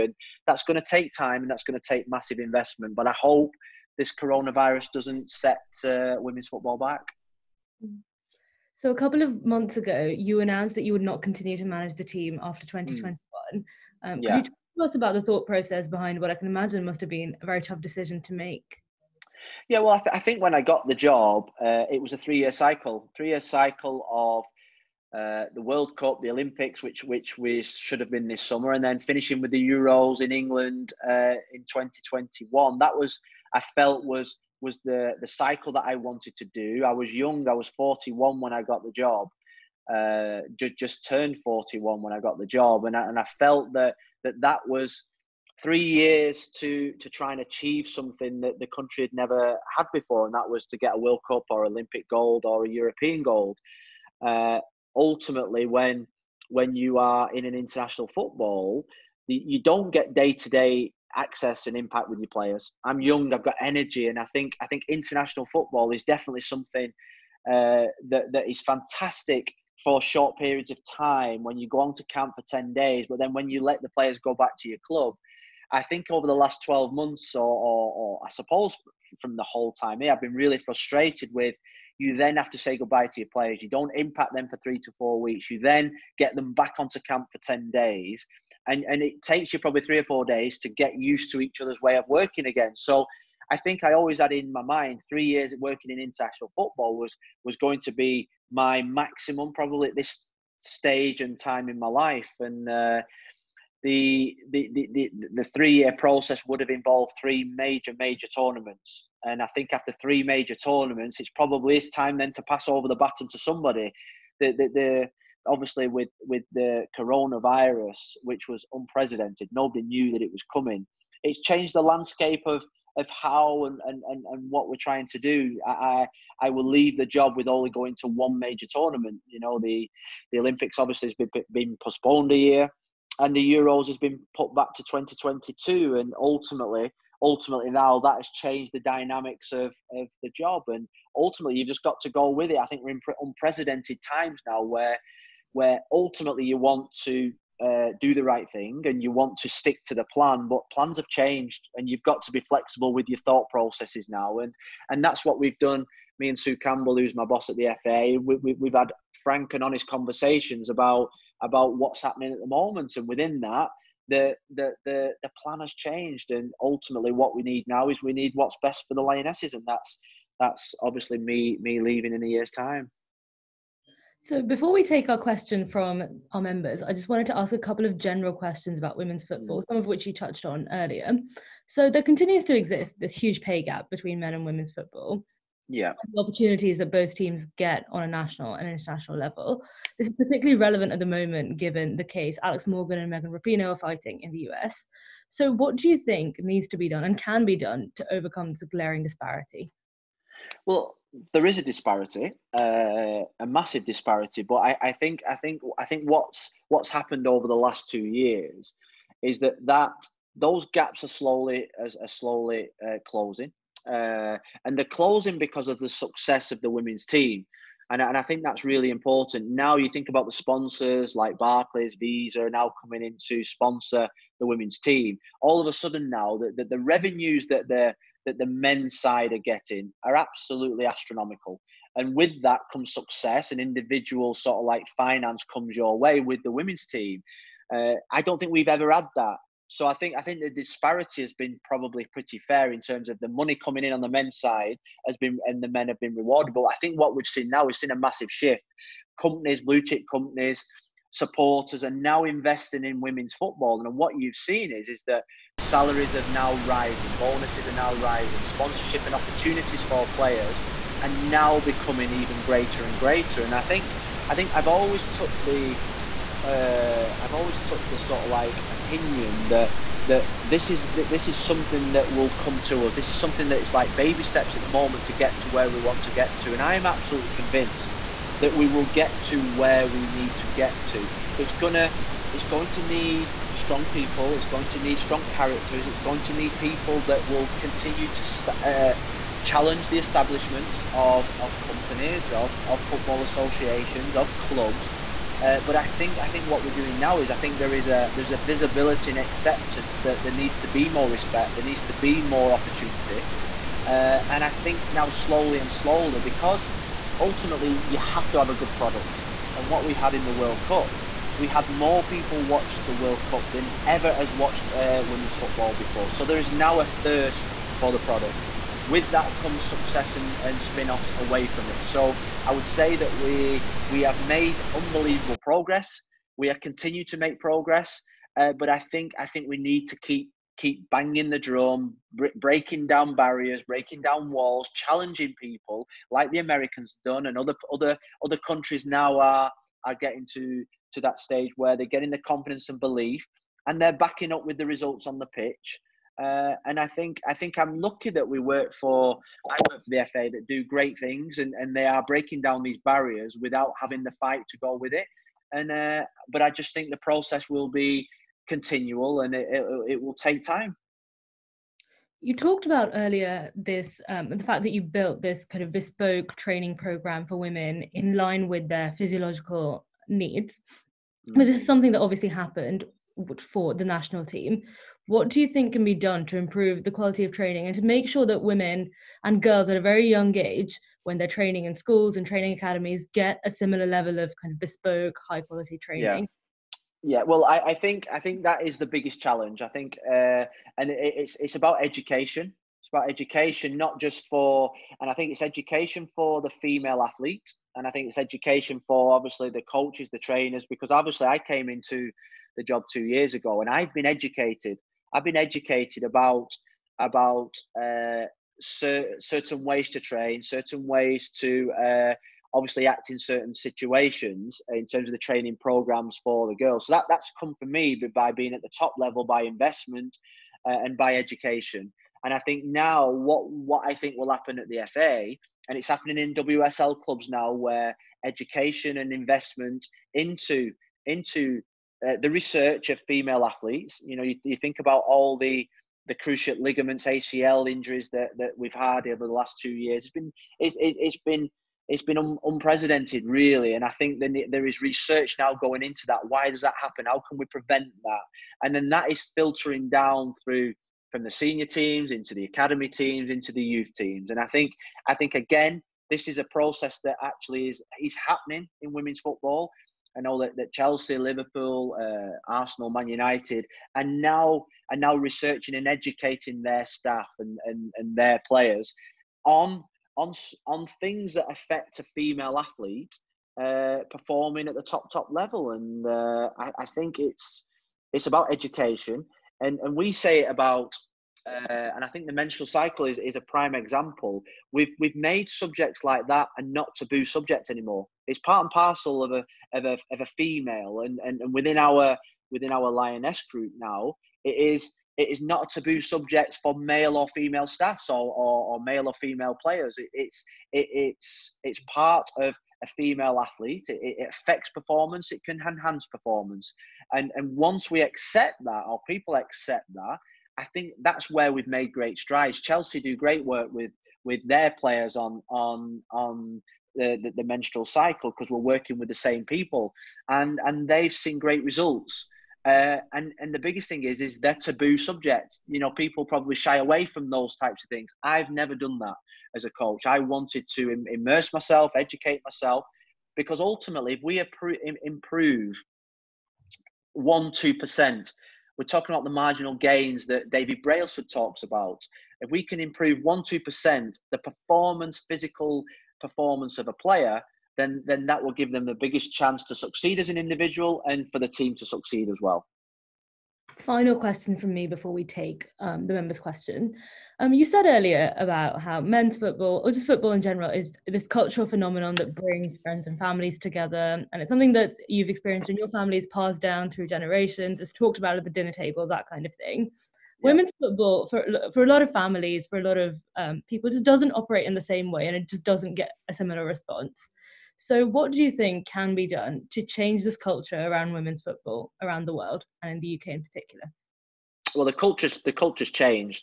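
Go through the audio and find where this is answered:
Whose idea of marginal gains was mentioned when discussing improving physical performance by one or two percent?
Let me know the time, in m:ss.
9:00.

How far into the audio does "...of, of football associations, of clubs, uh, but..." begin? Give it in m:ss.
4:52.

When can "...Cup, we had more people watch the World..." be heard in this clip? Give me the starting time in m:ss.
5:10.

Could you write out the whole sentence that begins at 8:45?
You know, people probably shy away from those types of things.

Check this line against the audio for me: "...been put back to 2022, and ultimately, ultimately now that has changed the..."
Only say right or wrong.
right.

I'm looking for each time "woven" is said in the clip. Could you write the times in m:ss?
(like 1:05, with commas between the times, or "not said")
not said.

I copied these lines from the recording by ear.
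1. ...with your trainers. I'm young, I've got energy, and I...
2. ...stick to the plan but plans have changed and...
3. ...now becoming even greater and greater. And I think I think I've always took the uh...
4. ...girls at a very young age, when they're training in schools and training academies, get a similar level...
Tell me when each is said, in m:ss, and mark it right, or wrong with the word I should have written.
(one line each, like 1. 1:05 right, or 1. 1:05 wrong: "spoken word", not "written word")
1. 1:02 wrong: "players", not "trainers"
2. 2:29 right
3. 4:21 right
4. 6:19 right.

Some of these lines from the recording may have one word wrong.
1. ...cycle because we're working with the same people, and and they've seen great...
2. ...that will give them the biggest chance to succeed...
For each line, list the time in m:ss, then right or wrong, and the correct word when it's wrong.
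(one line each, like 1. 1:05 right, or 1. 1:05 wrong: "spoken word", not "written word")
1. 8:37 right
2. 9:08 right.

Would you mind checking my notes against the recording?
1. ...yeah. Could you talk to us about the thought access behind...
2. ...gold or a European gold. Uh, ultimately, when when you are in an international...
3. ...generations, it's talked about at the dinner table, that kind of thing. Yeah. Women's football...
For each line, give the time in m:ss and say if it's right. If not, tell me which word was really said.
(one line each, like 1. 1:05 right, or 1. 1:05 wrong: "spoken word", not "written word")
1. 0:14 wrong: "process", not "access"
2. 0:52 right
3. 9:27 right.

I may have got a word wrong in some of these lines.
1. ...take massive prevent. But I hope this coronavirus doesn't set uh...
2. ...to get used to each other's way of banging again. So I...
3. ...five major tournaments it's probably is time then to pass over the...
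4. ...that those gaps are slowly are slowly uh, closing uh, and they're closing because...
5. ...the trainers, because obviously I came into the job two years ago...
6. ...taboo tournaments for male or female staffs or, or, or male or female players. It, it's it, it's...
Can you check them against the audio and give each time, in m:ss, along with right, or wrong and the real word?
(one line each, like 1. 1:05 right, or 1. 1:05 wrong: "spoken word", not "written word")
1. 0:01 wrong: "investment", not "prevent"
2. 1:30 wrong: "working", not "banging"
3. 1:50 wrong: "three", not "five"
4. 3:29 right
5. 6:40 right
6. 8:15 wrong: "subjects", not "tournaments".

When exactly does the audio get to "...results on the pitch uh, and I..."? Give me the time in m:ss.
5:44.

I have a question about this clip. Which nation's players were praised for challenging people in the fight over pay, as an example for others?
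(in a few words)
The Americans.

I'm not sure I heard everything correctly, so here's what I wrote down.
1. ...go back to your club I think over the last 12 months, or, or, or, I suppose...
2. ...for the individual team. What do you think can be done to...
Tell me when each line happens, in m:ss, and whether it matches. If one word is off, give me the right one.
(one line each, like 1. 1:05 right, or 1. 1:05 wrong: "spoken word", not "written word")
1. 1:14 right
2. 6:13 wrong: "national", not "individual".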